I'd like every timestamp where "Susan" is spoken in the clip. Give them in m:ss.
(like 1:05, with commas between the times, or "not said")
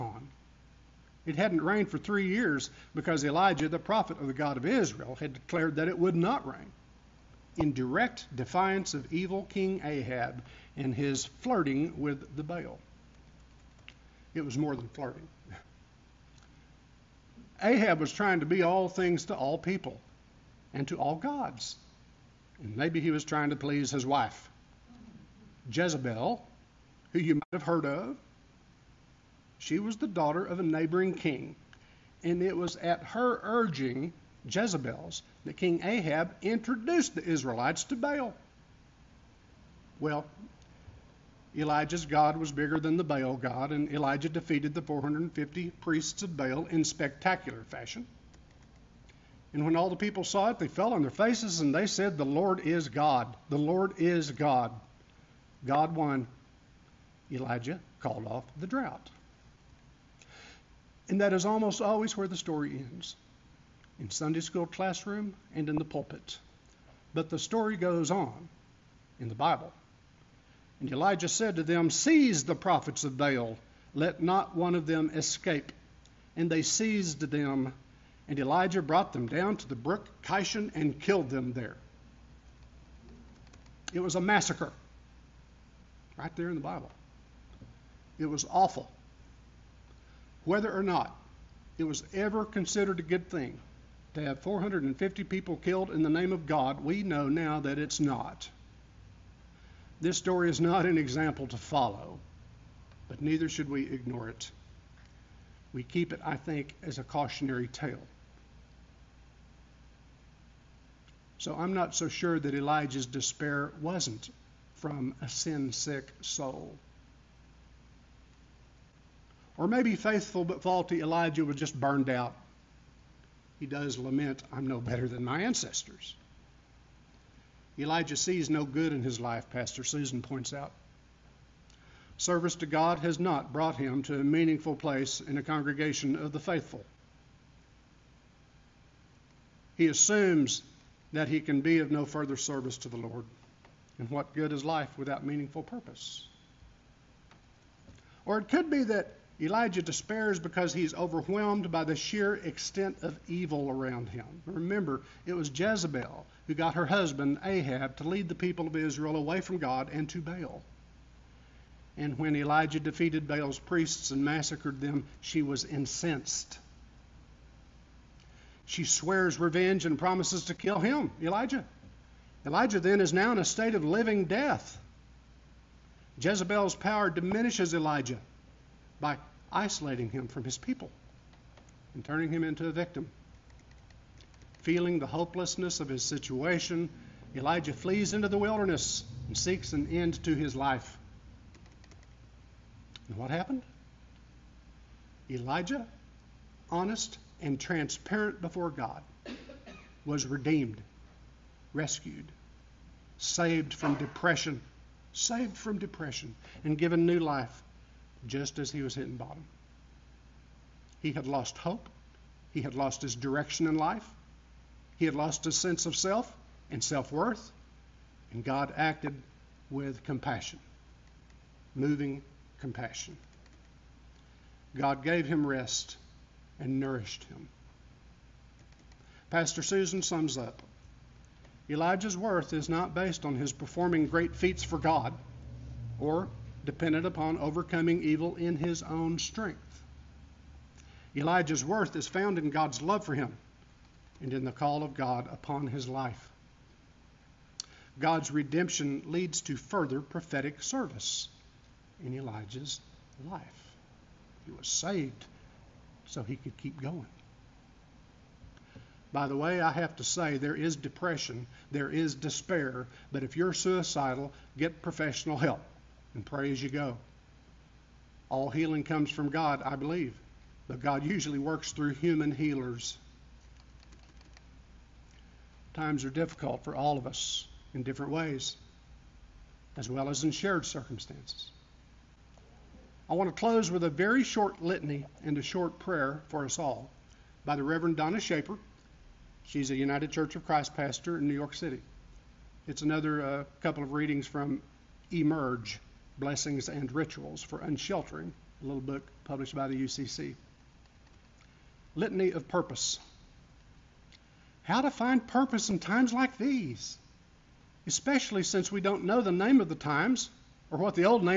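2:09, 3:49.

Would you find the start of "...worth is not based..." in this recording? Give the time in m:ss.
3:52.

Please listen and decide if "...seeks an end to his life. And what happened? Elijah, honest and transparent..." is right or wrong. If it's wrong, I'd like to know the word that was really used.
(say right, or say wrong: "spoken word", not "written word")
right.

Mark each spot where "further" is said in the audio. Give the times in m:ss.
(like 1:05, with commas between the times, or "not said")
2:22, 4:09.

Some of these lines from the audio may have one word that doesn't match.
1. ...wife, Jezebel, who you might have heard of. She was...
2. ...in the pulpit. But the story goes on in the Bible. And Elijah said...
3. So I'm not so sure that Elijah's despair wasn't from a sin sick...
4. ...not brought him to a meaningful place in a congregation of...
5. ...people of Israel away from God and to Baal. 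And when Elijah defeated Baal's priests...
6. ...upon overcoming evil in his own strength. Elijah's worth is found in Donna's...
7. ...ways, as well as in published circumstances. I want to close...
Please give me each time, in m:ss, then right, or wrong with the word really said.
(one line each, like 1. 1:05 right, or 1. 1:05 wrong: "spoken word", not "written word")
1. 0:24 right
2. 1:05 right
3. 1:51 right
4. 2:13 right
5. 2:38 right
6. 3:57 wrong: "God", not "Donna"
7. 4:38 wrong: "shared", not "published".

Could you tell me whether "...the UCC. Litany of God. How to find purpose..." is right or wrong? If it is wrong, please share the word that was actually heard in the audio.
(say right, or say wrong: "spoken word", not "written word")
wrong: "Purpose", not "God".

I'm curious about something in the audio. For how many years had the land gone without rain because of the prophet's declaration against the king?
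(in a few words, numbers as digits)
3.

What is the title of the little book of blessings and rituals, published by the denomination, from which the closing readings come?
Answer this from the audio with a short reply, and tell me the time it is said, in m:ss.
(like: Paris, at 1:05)
Emerge, at 4:55.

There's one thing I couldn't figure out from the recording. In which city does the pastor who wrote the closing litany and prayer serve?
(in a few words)
New York City.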